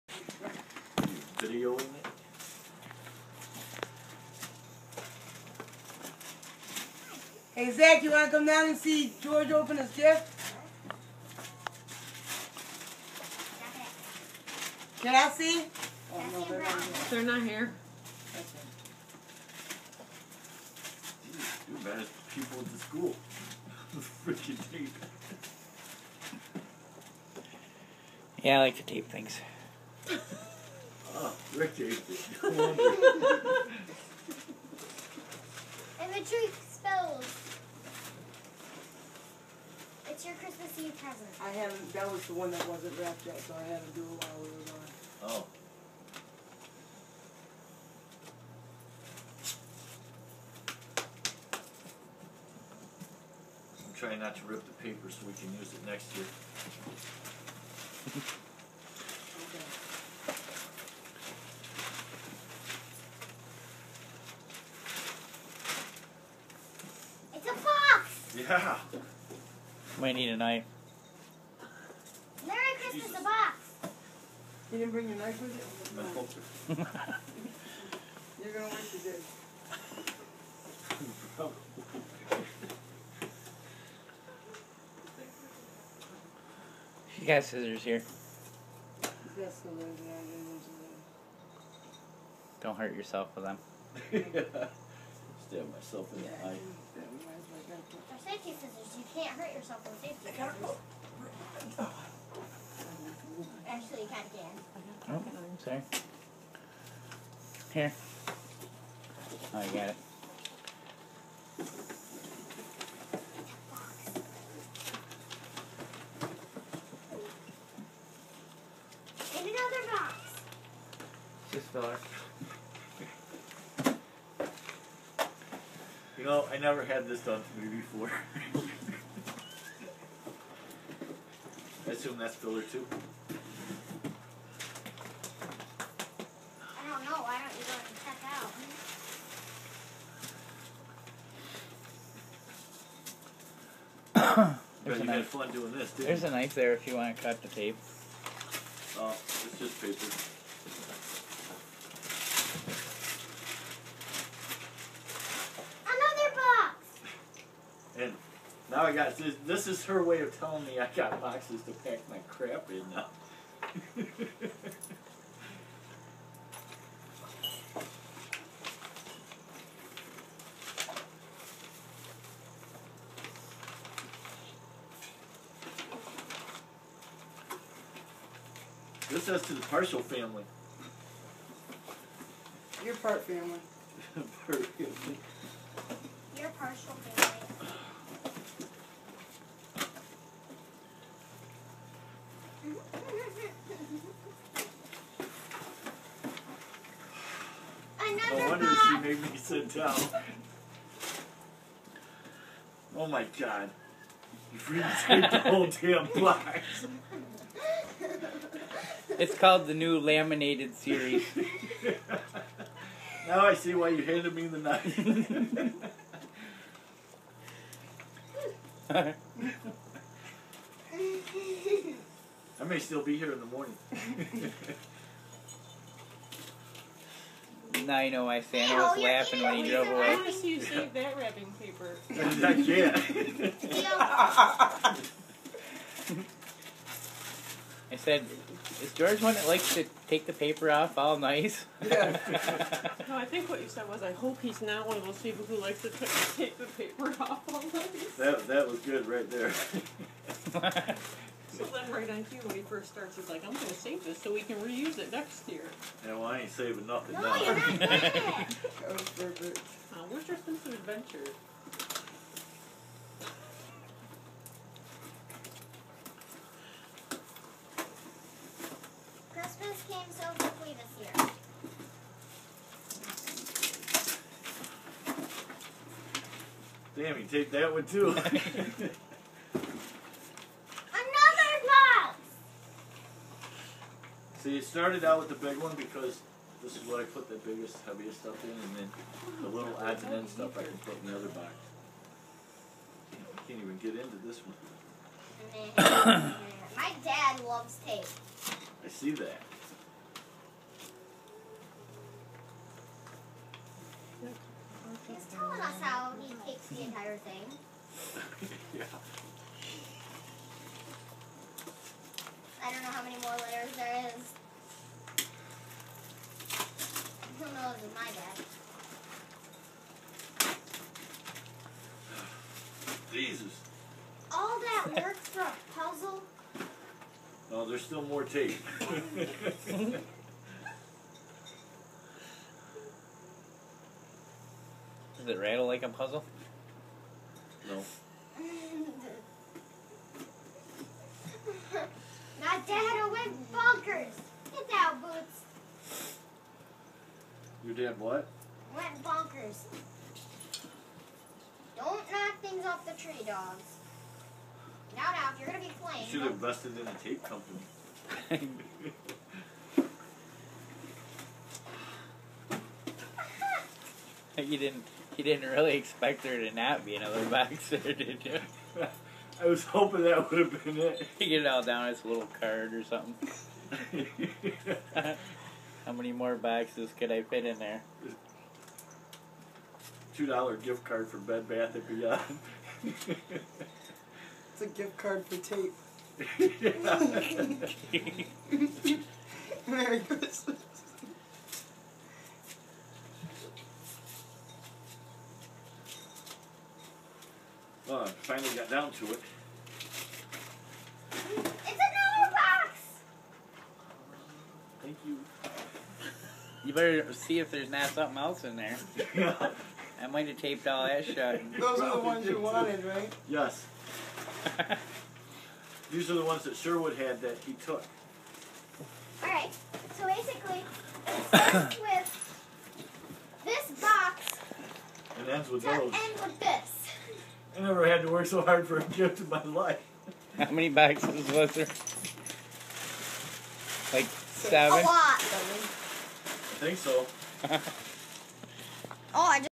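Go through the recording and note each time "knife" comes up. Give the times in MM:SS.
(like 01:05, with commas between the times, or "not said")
01:10, 01:15, 02:26, 03:34.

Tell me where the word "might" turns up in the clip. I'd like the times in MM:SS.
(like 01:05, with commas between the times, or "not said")
01:10, 06:50.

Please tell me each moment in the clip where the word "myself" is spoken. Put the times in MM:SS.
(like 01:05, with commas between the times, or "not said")
01:35.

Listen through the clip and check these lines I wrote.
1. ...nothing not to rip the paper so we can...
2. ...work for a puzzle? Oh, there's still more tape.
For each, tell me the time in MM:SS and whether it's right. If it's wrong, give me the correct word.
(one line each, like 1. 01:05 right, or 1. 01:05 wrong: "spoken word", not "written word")
1. 00:53 wrong: "trying", not "nothing"
2. 05:25 right.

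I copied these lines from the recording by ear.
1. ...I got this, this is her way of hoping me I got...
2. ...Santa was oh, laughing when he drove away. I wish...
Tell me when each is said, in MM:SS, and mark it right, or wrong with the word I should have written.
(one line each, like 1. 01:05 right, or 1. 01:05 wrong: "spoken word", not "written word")
1. 02:38 wrong: "telling", not "hoping"
2. 03:48 right.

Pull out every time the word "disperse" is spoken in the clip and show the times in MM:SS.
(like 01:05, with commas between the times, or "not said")
not said.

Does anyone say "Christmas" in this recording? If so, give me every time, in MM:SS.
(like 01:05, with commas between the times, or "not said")
00:40, 01:12, 04:29, 06:30.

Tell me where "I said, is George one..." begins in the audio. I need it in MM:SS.
03:57.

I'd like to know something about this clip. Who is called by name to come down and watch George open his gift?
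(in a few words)
Zach.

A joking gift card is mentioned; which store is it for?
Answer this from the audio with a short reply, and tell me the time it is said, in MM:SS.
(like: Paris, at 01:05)
Bed Bath and Beyond, at 06:21.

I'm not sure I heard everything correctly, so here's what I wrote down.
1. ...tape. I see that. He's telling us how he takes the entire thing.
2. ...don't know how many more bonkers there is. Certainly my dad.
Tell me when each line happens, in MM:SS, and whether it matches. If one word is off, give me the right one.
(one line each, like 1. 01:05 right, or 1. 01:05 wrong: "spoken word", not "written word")
1. 04:57 right
2. 05:12 wrong: "letters", not "bonkers".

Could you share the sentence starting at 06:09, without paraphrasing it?
I was hoping that would have been it.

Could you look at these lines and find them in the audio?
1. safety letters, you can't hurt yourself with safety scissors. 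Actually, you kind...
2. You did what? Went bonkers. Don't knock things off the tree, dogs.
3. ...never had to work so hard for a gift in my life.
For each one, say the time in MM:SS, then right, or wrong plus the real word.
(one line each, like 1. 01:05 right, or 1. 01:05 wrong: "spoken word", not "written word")
1. 01:38 wrong: "scissors", not "letters"
2. 05:47 right
3. 07:07 right.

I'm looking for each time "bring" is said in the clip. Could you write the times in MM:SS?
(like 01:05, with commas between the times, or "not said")
01:14.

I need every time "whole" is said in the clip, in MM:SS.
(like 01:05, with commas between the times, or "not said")
03:25.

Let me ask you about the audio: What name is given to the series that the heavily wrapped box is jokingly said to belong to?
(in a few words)
the new laminated series.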